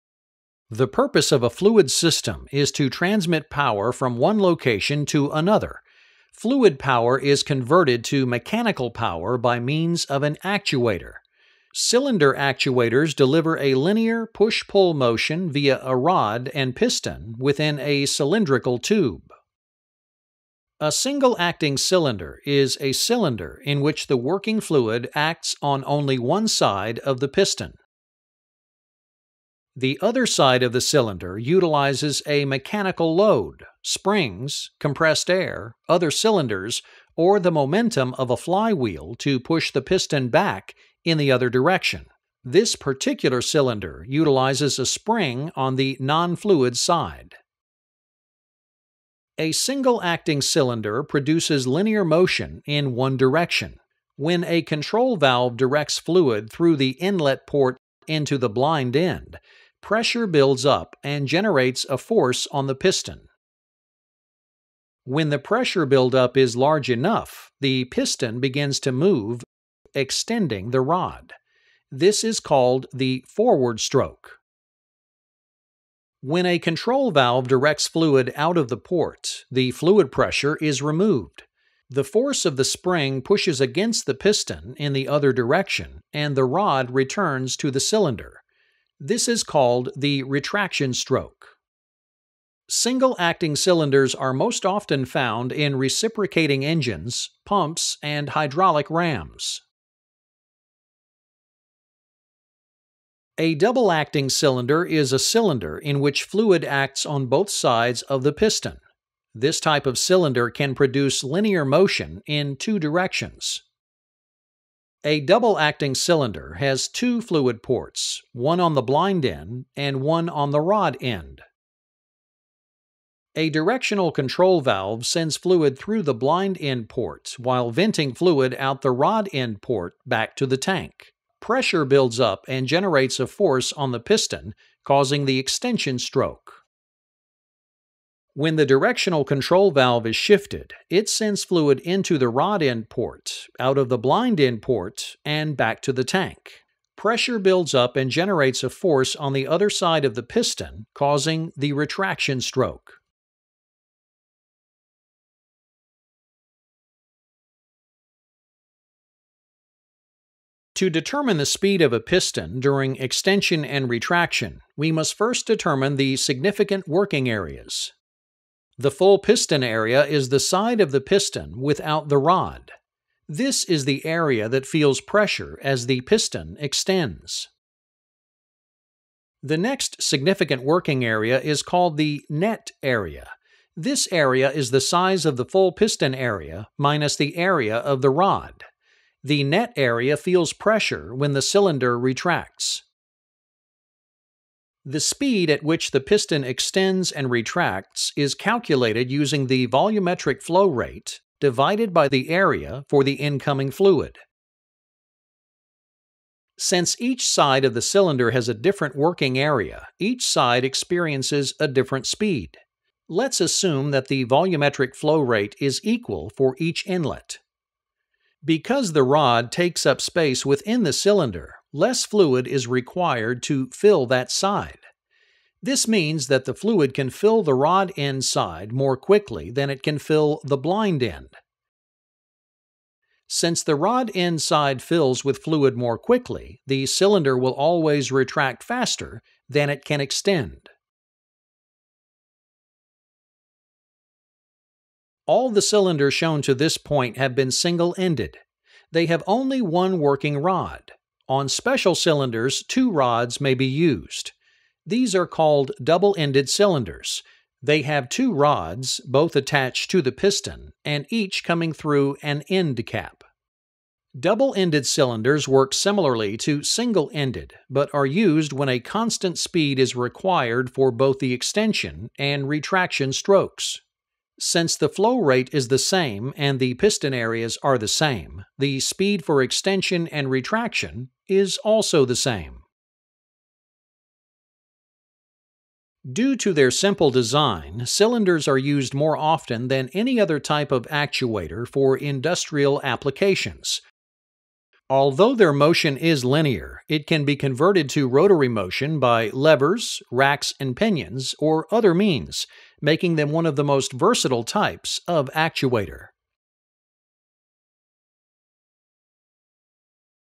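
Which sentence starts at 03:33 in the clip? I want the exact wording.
Let's assume that the volumetric flow rate is equal for each inlet.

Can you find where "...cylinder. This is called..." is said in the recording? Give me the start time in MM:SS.
01:27.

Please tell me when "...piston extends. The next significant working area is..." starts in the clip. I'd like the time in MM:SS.
02:56.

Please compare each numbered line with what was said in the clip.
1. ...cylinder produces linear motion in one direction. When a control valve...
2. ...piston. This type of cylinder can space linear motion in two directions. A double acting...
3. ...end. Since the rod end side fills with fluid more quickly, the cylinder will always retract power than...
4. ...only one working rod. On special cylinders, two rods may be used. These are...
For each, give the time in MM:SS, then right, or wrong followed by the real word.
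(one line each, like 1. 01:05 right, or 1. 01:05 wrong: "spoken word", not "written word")
1. 00:50 right
2. 01:48 wrong: "produce", not "space"
3. 03:51 wrong: "faster", not "power"
4. 04:09 right.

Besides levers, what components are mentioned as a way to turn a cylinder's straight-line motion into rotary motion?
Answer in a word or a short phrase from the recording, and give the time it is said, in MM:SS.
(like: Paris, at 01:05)
racks and pinions, at 05:00.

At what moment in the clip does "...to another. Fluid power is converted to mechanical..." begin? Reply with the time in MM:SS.
00:05.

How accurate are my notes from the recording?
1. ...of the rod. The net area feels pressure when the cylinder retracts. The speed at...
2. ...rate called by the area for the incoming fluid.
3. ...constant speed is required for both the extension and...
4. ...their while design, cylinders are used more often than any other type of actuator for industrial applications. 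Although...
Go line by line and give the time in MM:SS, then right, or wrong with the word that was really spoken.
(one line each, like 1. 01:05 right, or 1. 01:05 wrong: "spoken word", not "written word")
1. 03:07 right
2. 03:20 wrong: "divided", not "called"
3. 04:28 right
4. 04:46 wrong: "simple", not "while".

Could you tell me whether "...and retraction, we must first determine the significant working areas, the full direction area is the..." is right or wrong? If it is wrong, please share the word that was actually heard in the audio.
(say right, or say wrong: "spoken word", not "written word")
wrong: "piston", not "direction".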